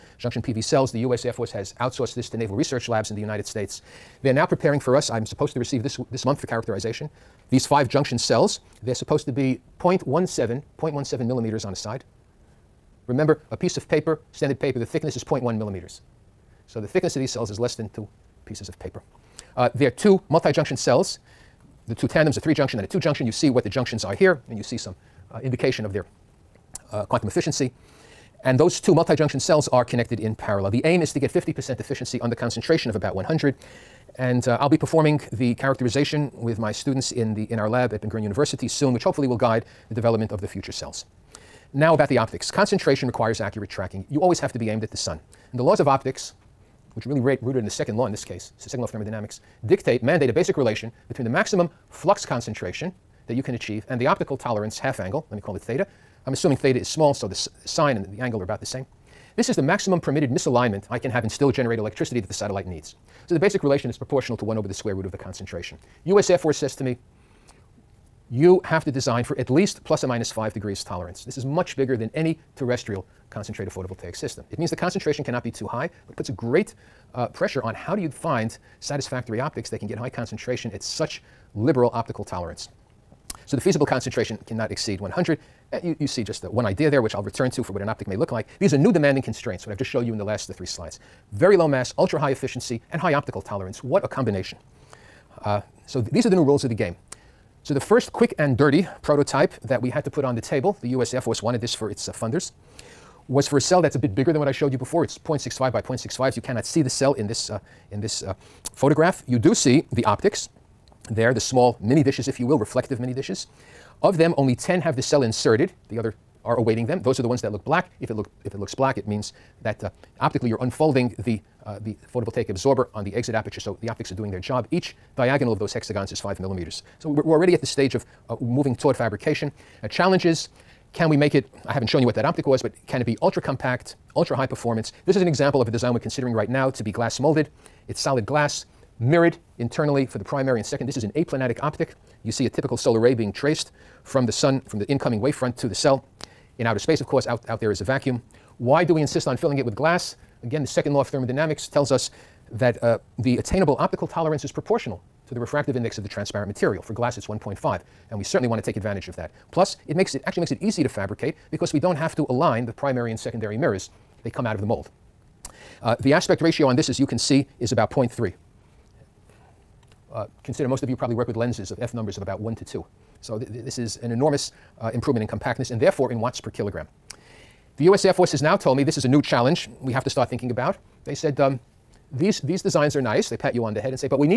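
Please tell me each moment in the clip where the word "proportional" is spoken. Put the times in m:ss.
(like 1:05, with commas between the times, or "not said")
1:03, 2:34.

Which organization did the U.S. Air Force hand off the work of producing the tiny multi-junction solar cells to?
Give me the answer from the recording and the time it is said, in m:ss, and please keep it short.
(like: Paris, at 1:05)
Naval Research Labs, at 0:02.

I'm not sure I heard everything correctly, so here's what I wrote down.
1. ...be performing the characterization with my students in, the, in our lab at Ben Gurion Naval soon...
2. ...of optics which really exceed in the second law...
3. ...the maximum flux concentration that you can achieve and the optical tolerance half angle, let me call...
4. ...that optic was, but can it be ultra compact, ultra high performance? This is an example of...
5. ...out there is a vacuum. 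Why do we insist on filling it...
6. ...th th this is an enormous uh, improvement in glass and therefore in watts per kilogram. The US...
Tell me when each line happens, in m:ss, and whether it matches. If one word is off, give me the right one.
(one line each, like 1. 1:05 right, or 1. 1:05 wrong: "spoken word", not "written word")
1. 0:34 wrong: "University", not "Naval"
2. 0:45 wrong: "rooted", not "exceed"
3. 0:51 right
4. 2:12 right
5. 2:27 right
6. 2:53 wrong: "compactness", not "glass".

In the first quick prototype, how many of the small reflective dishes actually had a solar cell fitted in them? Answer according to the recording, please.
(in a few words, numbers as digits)
10.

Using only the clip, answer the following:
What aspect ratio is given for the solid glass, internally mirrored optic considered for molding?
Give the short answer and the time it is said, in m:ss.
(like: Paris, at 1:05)
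0.3, at 2:47.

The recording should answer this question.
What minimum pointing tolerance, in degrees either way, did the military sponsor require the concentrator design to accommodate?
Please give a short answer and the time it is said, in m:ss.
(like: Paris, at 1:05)
5 degrees, at 1:10.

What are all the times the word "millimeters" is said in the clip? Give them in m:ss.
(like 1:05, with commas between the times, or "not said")
0:11, 0:15, 2:06.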